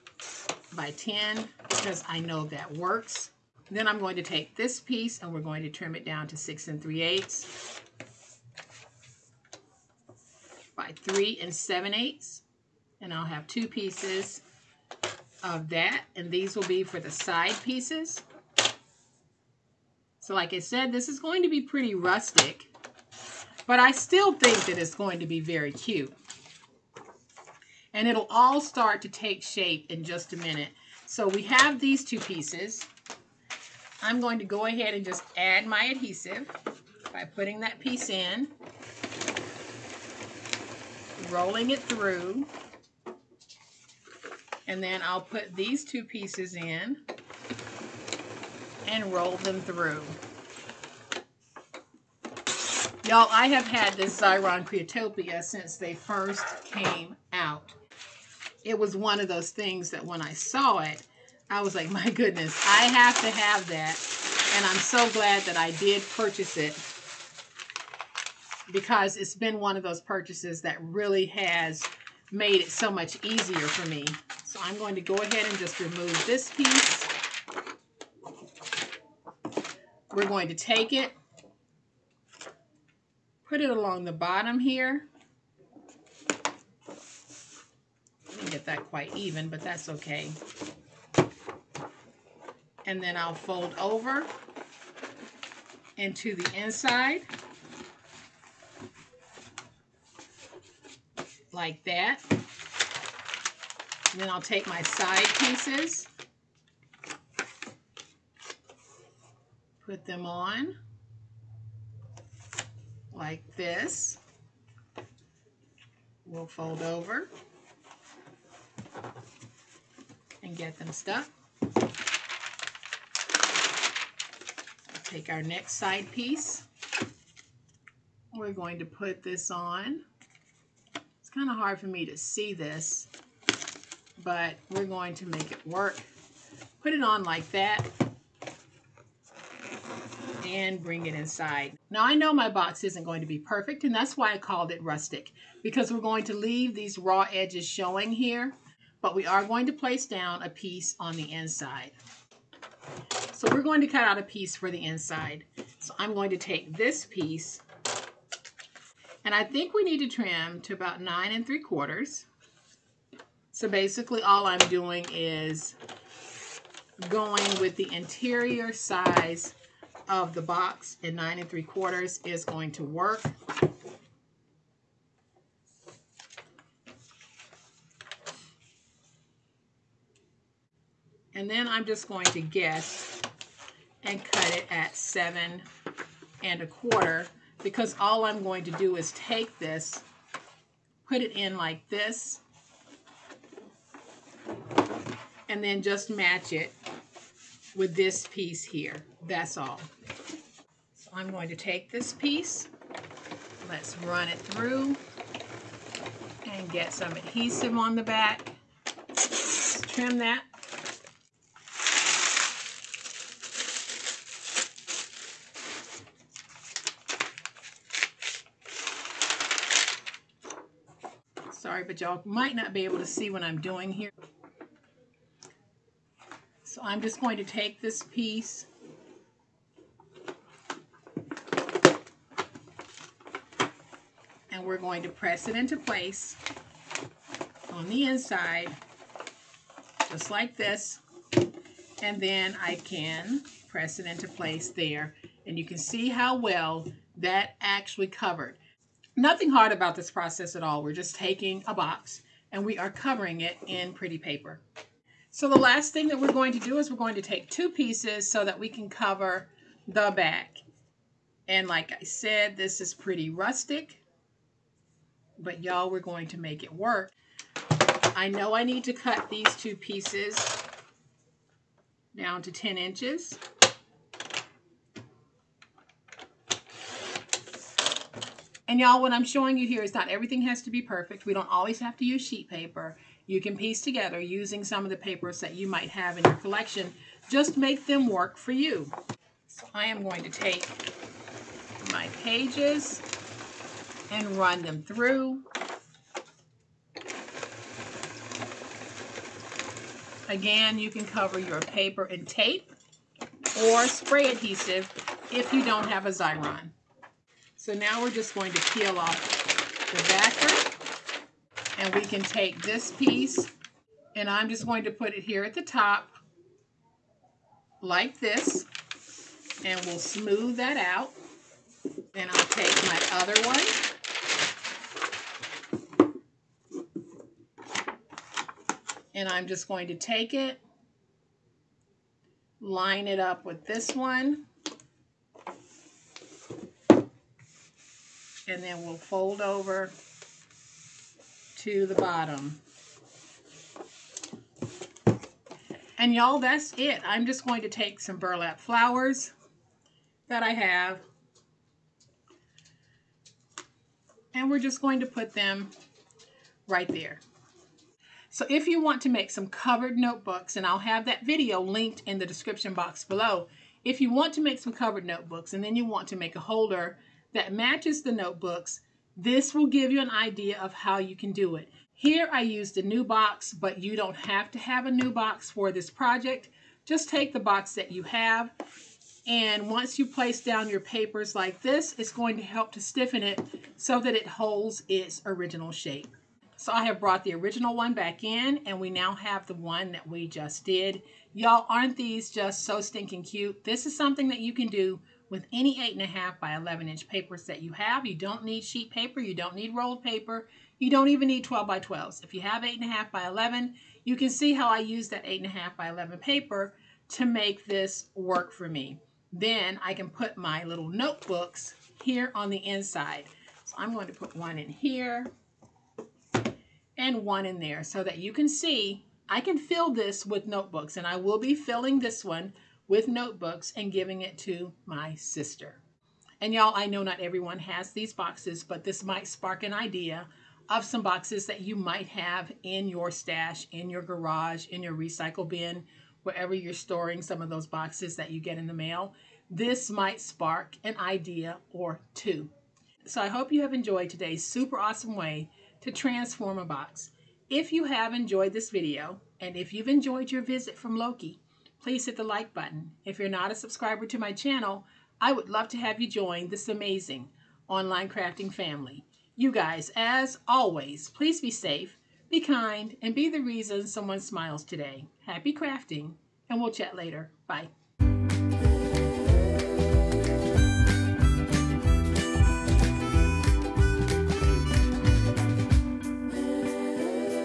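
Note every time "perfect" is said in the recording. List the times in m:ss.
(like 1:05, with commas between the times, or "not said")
2:23, 4:40.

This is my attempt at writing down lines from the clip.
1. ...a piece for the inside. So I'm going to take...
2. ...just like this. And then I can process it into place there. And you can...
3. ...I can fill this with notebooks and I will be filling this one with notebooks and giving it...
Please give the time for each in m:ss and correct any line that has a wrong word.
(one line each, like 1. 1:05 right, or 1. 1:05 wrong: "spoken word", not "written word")
1. 2:34 right
2. 4:00 wrong: "press", not "process"
3. 6:59 right.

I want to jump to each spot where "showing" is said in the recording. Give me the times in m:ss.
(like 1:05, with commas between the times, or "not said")
2:27, 4:39.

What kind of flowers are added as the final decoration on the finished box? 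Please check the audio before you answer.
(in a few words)
burlap flowers.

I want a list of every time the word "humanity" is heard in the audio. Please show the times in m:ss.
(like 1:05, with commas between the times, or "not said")
not said.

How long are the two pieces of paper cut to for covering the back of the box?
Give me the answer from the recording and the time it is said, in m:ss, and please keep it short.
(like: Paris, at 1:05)
10 inches, at 4:32.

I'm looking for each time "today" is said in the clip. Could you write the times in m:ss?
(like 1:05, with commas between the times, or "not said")
7:24, 7:44.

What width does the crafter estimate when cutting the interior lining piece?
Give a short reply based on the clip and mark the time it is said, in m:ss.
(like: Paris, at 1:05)
7 1/4, at 3:04.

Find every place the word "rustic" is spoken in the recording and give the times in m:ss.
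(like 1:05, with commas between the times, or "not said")
0:21, 2:24, 4:23.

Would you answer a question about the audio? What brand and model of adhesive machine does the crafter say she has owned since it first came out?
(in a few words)
Xyron Creatopia.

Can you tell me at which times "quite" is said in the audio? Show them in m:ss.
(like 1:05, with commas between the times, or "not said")
1:28.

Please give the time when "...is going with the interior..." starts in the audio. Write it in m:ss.
2:45.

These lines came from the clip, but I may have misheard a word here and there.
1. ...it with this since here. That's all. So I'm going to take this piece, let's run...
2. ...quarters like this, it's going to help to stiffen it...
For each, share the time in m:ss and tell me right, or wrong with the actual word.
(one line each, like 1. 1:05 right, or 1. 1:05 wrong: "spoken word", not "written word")
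1. 3:16 wrong: "piece", not "since"
2. 6:20 wrong: "papers", not "quarters".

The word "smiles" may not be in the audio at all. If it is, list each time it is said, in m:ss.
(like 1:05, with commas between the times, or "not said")
7:44.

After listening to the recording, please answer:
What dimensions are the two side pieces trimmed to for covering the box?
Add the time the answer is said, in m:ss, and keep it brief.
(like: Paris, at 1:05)
6 3/8 by 3 7/8, at 0:06.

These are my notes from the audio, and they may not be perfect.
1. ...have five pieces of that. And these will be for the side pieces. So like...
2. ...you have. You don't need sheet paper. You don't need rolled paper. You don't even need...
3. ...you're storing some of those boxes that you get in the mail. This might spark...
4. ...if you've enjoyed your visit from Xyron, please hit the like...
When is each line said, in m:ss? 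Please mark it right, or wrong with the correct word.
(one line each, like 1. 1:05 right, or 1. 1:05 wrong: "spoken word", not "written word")
1. 0:13 wrong: "two", not "five"
2. 6:37 right
3. 7:16 right
4. 7:29 wrong: "Loki", not "Xyron".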